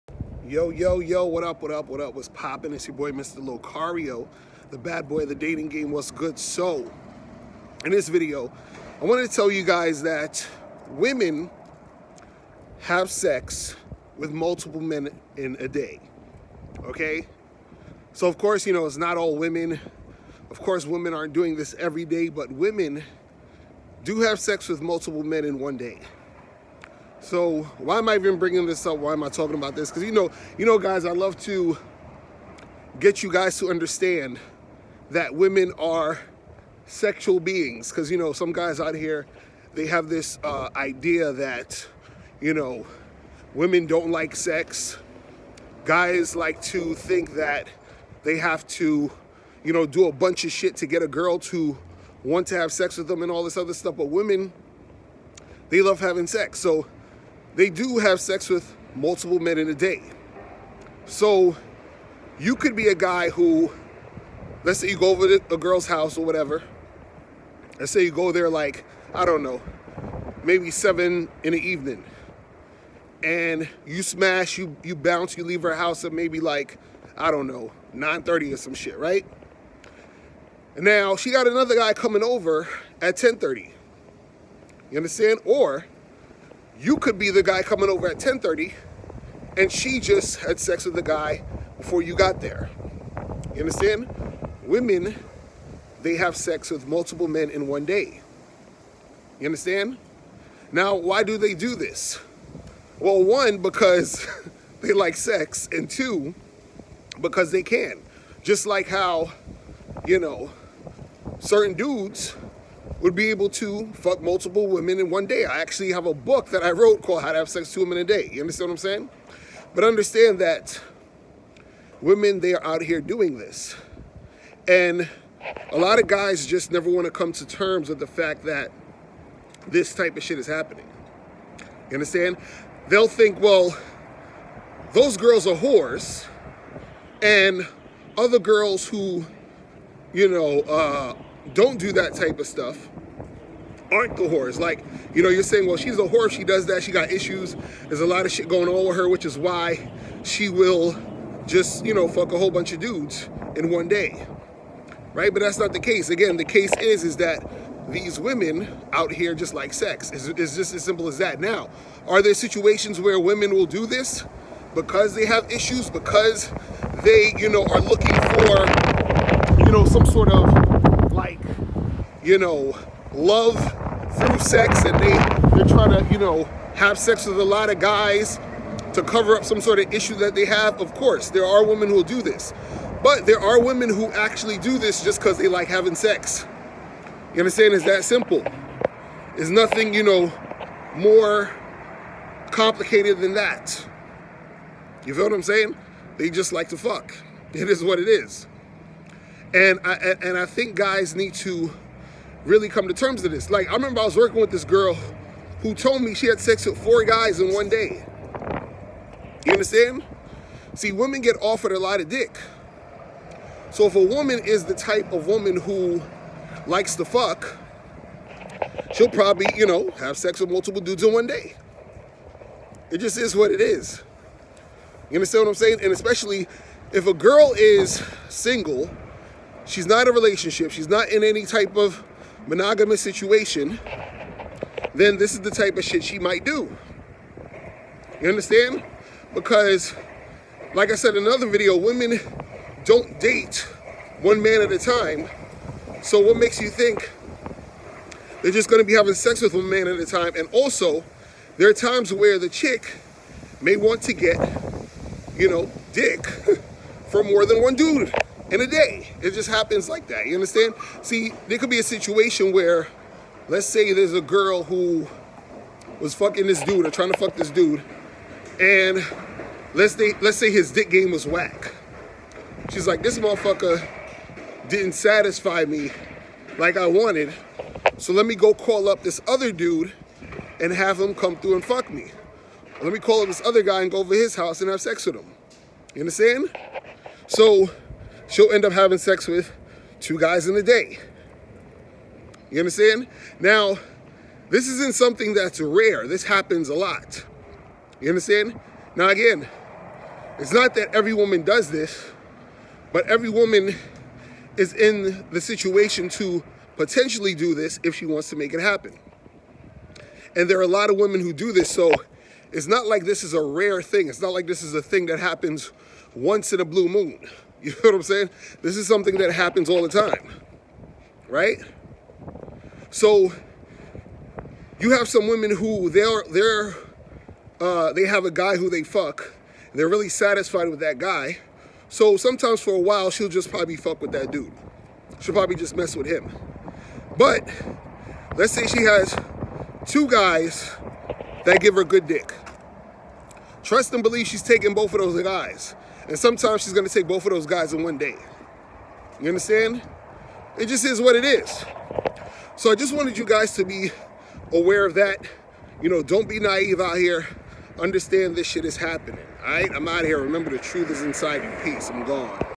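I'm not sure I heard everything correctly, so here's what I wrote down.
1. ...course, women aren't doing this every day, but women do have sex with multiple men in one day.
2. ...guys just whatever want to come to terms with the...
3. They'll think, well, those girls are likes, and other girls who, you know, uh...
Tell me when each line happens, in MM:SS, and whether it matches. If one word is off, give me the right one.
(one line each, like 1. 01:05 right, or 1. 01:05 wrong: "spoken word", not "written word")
1. 00:20 right
2. 02:06 wrong: "never", not "whatever"
3. 02:12 wrong: "whores", not "likes".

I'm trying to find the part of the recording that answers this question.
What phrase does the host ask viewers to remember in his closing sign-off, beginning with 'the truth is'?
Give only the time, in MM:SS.
06:00.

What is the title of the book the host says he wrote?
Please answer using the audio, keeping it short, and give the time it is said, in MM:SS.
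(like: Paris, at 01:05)
How to Have Sex Two Women a Day, at 01:57.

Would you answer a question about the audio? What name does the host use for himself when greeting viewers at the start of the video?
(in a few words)
Mr. Locario.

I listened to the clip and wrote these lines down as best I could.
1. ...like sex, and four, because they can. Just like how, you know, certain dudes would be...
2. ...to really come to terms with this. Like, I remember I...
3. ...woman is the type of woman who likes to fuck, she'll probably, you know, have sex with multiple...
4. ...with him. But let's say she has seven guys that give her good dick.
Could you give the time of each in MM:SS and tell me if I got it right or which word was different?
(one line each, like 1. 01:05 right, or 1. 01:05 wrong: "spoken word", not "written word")
1. 01:44 wrong: "two", not "four"
2. 03:21 right
3. 03:34 right
4. 05:35 wrong: "two", not "seven".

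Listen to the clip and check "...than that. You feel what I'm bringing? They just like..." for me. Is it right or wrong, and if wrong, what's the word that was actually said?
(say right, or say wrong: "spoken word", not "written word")
wrong: "saying", not "bringing".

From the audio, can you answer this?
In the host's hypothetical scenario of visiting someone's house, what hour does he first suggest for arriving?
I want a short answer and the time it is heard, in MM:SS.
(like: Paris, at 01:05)
7 in the evening, at 01:10.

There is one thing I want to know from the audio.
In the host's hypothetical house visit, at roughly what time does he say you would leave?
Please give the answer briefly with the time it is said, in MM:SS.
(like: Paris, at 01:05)
9:30, at 01:17.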